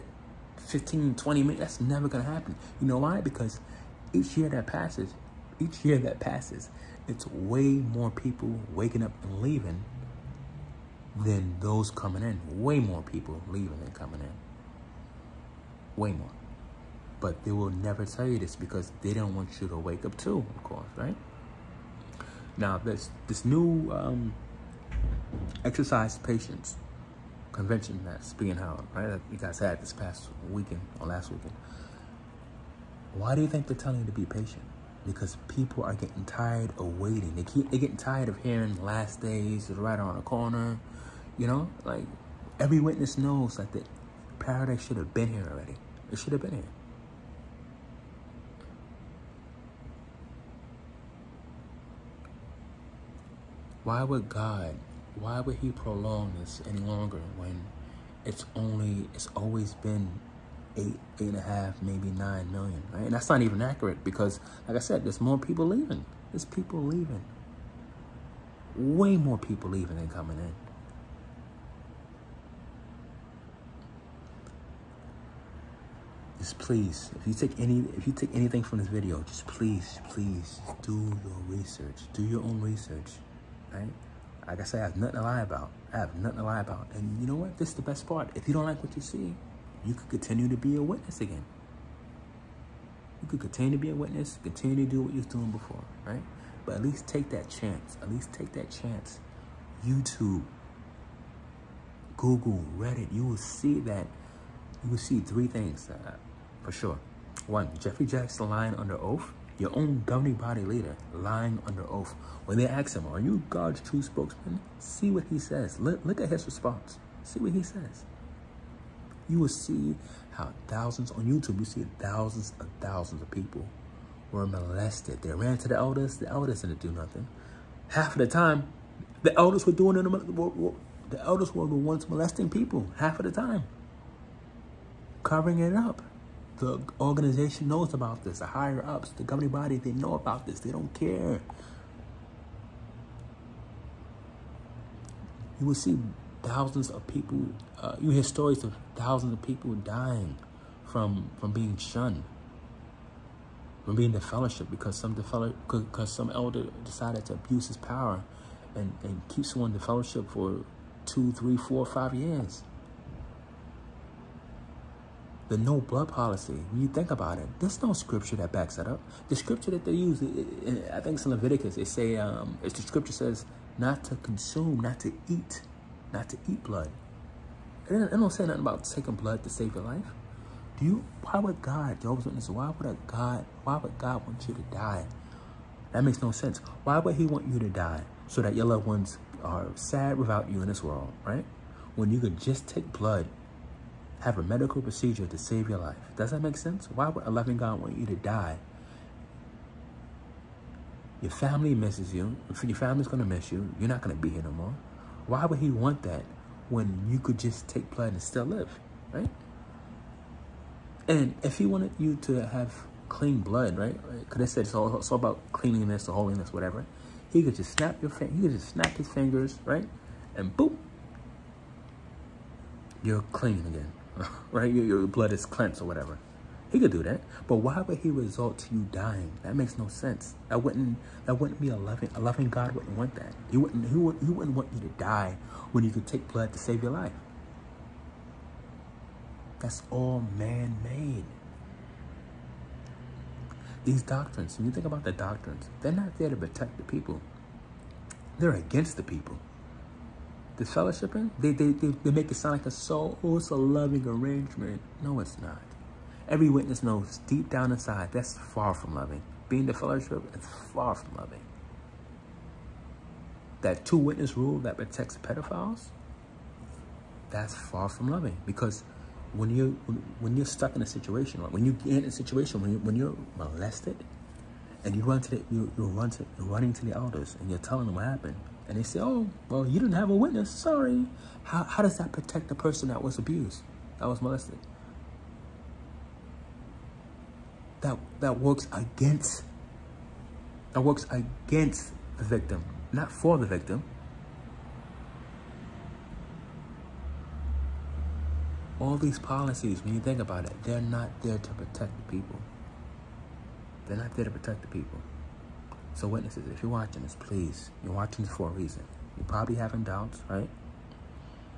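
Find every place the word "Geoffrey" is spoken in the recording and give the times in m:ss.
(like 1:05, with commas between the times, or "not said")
1:47.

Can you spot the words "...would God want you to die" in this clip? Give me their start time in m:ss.
3:03.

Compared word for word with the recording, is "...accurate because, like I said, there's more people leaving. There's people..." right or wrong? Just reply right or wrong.
right.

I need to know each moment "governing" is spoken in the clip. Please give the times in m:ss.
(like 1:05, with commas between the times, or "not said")
1:50, 2:19.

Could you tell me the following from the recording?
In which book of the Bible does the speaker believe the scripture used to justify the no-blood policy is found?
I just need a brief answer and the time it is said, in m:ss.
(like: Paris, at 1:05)
Leviticus, at 2:51.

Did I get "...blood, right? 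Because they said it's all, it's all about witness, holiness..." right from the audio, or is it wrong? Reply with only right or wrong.
wrong.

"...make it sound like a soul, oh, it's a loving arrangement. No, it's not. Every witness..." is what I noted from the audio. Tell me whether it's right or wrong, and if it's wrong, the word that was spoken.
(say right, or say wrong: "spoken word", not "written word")
right.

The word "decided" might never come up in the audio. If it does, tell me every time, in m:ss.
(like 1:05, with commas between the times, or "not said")
2:36.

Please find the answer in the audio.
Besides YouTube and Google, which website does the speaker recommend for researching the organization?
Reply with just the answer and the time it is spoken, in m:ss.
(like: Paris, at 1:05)
Reddit, at 1:42.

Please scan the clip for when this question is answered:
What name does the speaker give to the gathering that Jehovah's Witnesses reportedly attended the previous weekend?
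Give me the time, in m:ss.
0:25.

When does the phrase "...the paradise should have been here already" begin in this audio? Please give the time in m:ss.
0:43.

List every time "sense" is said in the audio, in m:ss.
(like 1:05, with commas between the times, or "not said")
3:06, 3:16, 3:49.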